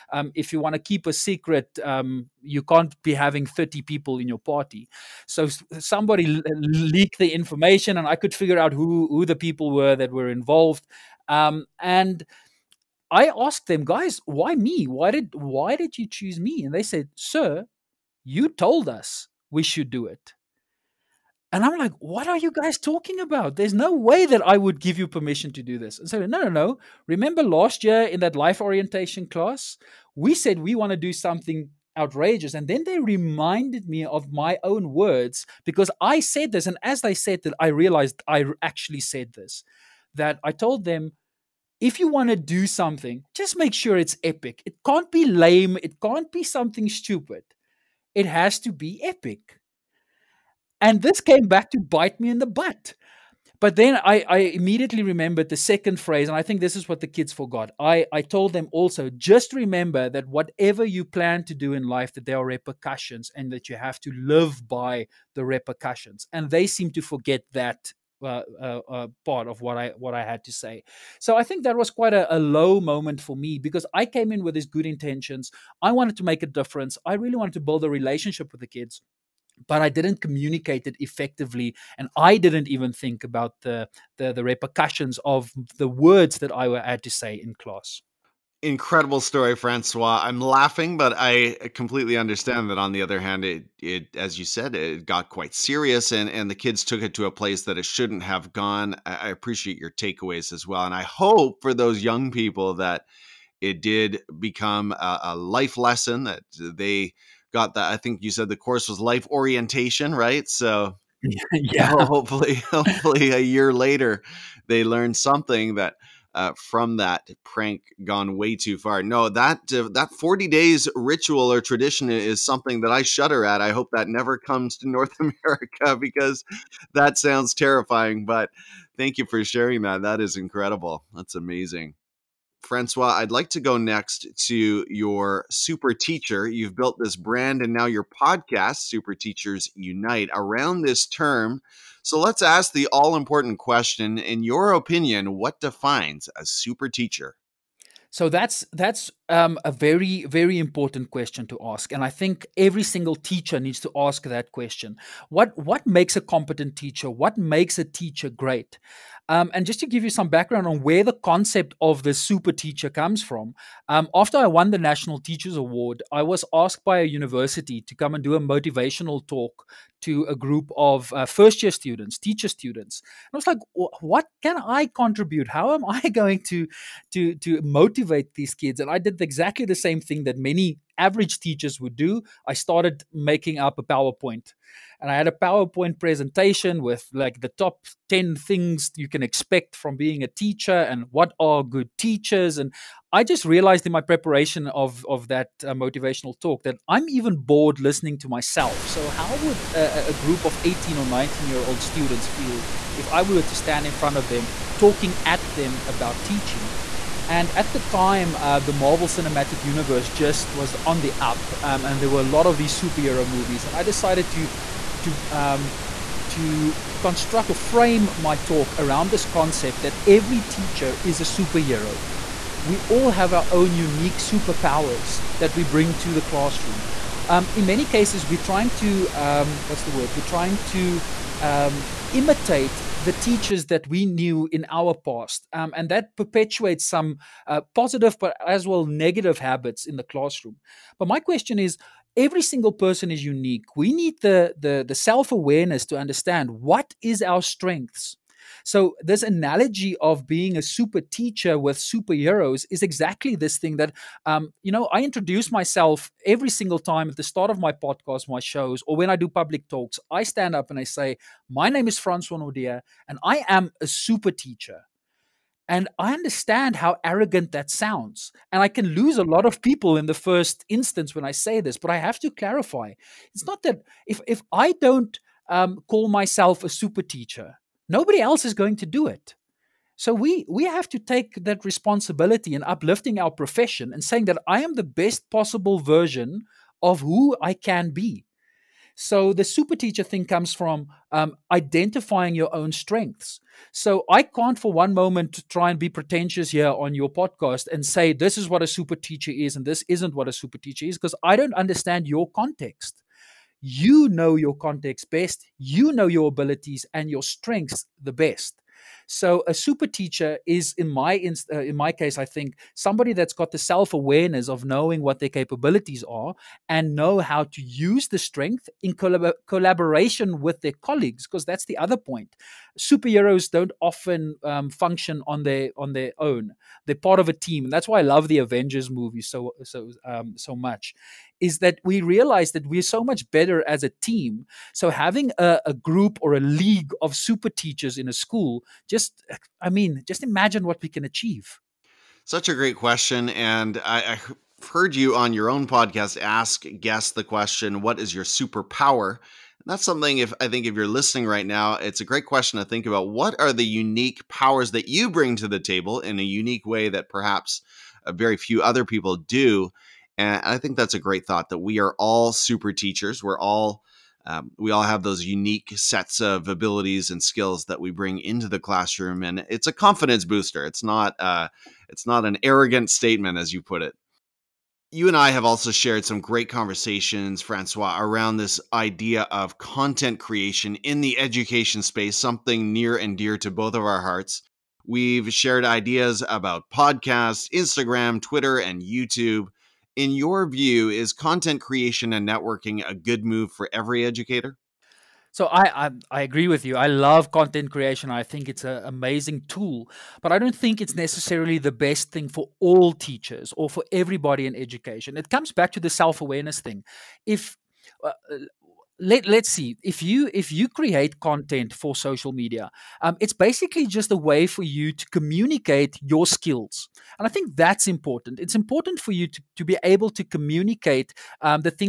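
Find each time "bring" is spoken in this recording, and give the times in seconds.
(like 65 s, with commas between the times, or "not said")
225 s, 355 s, 367 s.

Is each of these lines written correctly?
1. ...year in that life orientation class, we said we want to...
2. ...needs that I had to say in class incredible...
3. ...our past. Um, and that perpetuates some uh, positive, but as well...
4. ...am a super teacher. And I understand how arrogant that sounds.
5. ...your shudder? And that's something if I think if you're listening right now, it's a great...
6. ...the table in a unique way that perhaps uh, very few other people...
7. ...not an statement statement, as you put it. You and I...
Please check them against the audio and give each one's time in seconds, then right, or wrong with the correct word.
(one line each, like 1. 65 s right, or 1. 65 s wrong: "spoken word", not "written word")
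1. 27 s right
2. 85 s wrong: "words", not "needs"
3. 234 s right
4. 263 s right
5. 348 s wrong: "superpower", not "shudder"
6. 355 s right
7. 372 s wrong: "arrogant", not "statement".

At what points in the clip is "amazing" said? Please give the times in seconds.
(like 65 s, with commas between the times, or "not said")
131 s, 398 s.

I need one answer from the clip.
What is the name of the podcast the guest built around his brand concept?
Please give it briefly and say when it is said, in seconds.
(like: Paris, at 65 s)
Super Teachers Unite, at 138 s.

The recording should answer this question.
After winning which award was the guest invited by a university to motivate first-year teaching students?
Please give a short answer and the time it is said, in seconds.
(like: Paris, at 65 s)
National Teachers Award, at 164 s.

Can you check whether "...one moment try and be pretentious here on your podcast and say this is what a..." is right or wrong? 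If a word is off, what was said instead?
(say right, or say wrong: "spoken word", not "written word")
right.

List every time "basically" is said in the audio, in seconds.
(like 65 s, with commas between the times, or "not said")
413 s.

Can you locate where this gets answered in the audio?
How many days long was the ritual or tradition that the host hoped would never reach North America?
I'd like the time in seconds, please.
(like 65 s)
120 s.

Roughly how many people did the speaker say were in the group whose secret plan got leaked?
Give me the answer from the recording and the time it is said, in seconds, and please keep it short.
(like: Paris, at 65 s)
30, at 3 s.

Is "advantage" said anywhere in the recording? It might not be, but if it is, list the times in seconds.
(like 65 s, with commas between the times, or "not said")
not said.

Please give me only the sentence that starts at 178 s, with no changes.
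And I did exactly the same thing that many average teachers would do, I started making up a PowerPoint.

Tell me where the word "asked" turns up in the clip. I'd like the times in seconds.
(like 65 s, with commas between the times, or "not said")
13 s, 166 s.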